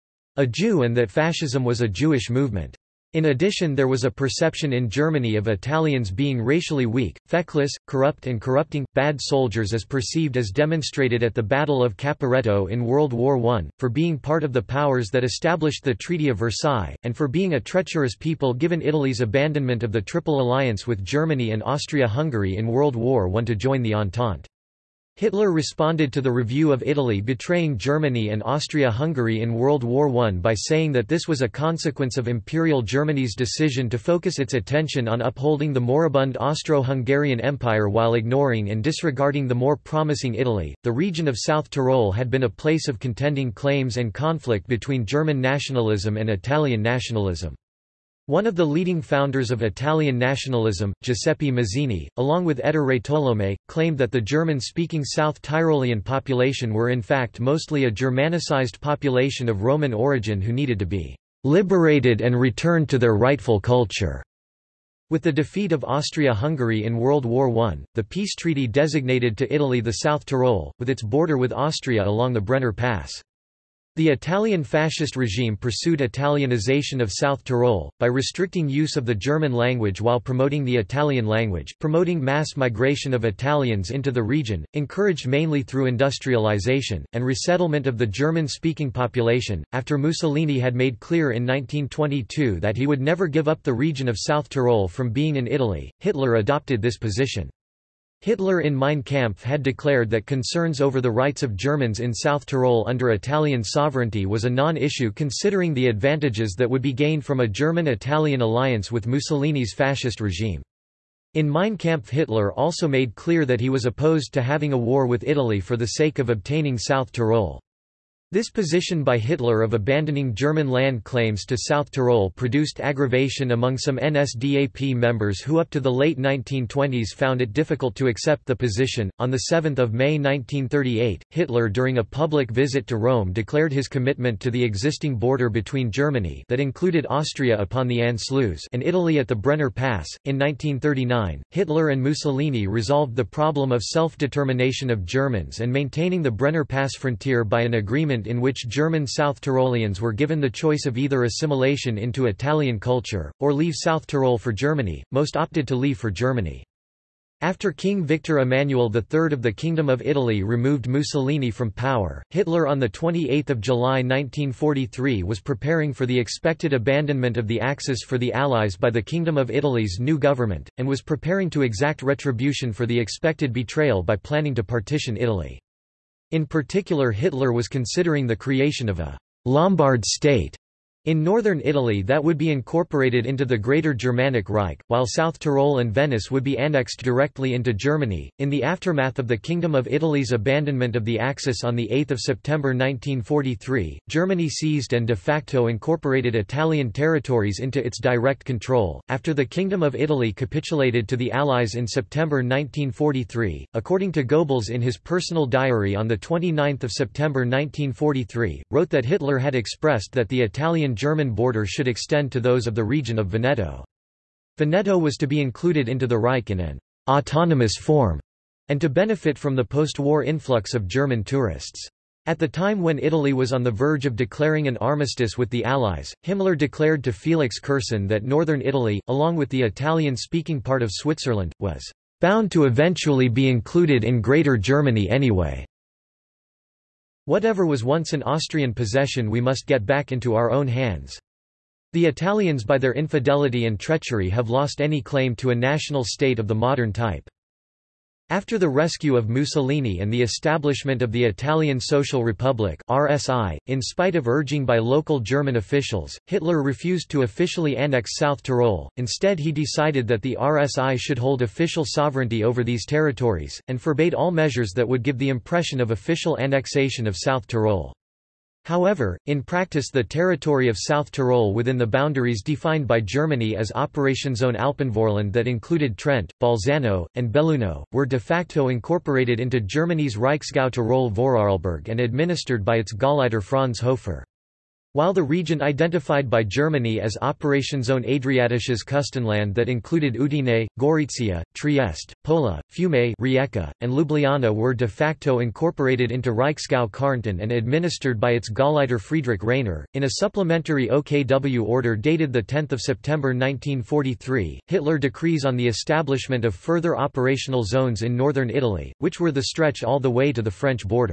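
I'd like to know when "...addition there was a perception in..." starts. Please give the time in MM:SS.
00:03.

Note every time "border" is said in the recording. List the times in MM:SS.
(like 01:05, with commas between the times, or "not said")
01:11, 02:15, 03:31.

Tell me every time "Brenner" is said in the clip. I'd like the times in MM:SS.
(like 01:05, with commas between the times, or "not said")
01:12, 02:19, 02:26.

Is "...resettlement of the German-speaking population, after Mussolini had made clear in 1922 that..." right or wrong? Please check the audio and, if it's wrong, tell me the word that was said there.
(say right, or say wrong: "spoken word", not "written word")
right.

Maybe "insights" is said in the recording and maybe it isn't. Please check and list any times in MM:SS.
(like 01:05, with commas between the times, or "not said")
not said.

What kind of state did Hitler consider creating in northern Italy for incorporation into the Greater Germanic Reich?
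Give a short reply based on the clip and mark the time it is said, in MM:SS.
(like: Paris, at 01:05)
Lombard state, at 02:59.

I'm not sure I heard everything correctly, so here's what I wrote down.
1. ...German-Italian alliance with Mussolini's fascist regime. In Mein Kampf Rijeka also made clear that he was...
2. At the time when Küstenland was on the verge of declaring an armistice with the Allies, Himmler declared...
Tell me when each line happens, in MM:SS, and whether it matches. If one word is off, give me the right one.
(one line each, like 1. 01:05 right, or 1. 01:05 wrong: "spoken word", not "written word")
1. 01:47 wrong: "Hitler", not "Rijeka"
2. 03:42 wrong: "Italy", not "Küstenland".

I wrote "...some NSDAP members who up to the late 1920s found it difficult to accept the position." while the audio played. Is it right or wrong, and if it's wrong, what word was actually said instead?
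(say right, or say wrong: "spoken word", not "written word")
right.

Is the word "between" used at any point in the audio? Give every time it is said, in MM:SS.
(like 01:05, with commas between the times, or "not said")
00:44, 02:15.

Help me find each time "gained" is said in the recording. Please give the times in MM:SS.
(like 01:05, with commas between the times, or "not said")
01:46.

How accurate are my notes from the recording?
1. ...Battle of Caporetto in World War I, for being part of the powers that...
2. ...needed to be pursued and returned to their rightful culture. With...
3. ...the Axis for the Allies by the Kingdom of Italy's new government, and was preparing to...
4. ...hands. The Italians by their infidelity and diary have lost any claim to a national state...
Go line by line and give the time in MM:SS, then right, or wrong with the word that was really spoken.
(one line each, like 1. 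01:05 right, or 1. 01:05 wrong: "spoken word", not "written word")
1. 00:11 right
2. 01:00 wrong: "liberated", not "pursued"
3. 02:47 right
4. 04:00 wrong: "treachery", not "diary".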